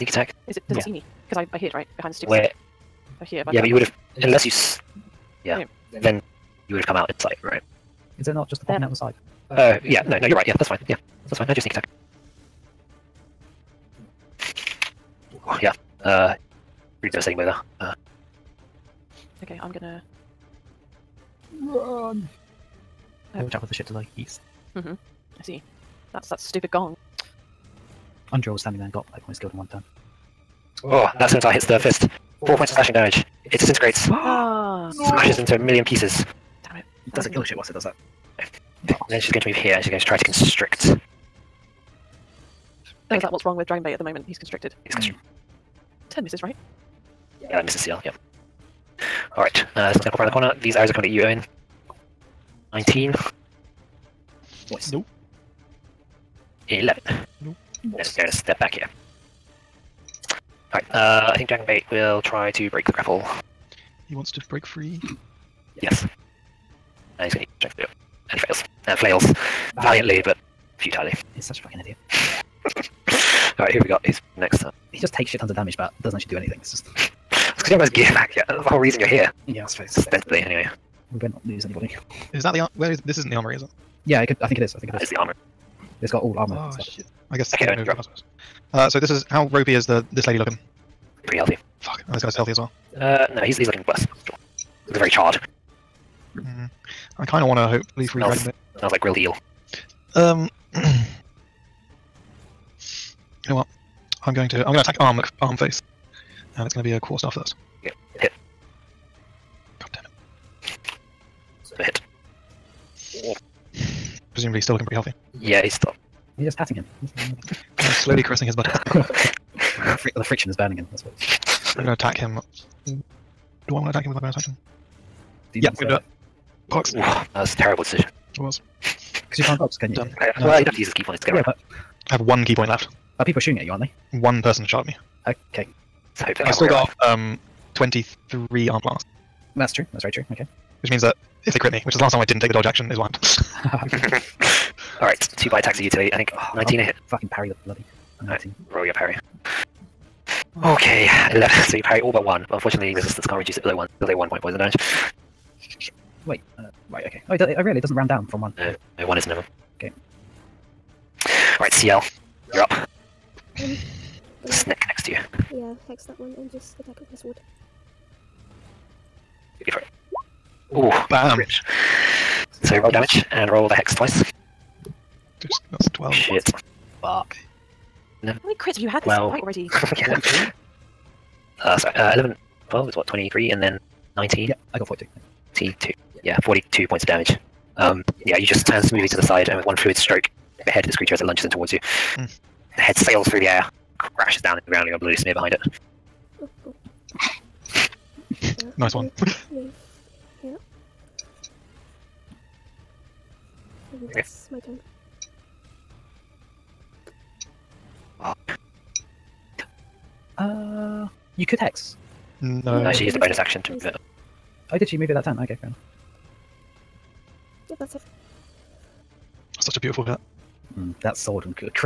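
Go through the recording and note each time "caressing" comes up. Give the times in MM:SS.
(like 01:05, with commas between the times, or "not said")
01:58.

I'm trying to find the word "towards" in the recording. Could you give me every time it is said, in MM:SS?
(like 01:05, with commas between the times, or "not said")
03:11.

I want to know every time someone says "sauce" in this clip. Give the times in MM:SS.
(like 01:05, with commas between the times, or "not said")
not said.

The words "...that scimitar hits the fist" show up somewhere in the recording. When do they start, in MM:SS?
00:31.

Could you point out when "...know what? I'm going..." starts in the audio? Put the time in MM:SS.
01:43.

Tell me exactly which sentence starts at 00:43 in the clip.
Oh, is that what's wrong with Dragonbait at the moment?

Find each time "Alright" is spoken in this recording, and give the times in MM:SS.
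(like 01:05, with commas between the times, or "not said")
00:49, 01:00, 01:13, 02:25.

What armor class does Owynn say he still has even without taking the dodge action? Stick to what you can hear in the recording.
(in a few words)
23.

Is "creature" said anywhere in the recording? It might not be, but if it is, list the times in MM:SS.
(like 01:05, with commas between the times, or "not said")
03:10.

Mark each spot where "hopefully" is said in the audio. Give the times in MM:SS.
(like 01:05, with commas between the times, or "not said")
01:37.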